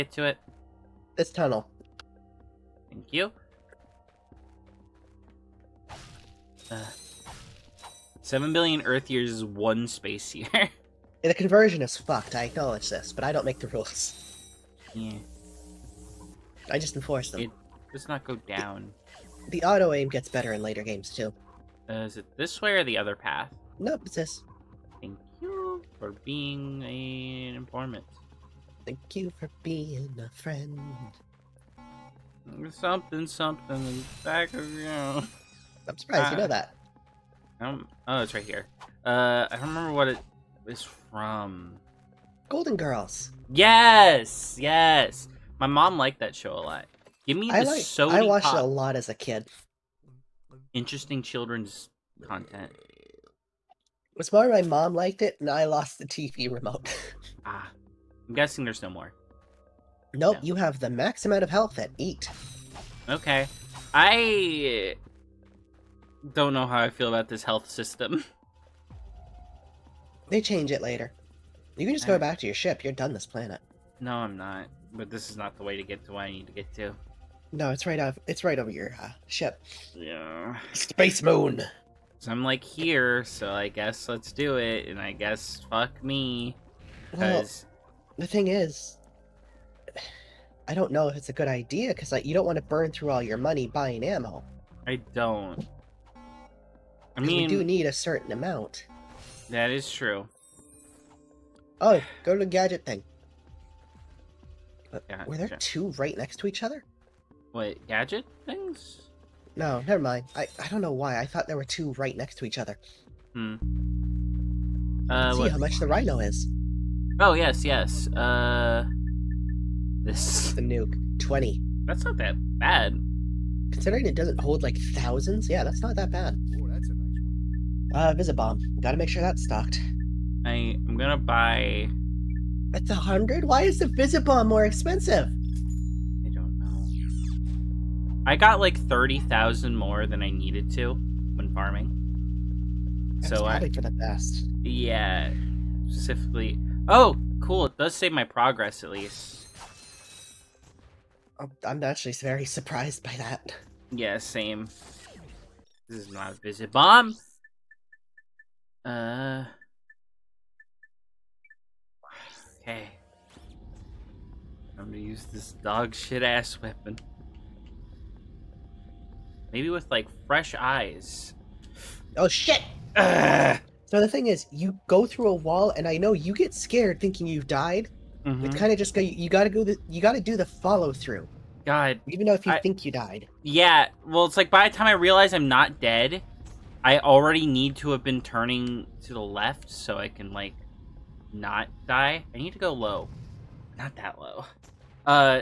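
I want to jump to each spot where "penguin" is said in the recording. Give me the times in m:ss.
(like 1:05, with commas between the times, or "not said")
not said.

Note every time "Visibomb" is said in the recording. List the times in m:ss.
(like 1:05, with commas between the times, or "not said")
2:08, 2:13, 2:36.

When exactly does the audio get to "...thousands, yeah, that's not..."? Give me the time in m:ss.
2:04.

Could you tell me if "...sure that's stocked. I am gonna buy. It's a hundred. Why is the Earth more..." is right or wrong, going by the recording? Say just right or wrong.
wrong.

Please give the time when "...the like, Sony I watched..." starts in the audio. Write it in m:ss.
0:47.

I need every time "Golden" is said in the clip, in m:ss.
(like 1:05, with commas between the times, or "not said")
0:42.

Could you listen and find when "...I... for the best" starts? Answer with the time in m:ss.
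2:23.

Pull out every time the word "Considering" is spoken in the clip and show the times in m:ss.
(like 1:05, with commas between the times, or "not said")
2:03.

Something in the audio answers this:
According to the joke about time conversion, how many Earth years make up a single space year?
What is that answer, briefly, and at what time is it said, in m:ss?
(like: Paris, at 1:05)
7 billion, at 0:08.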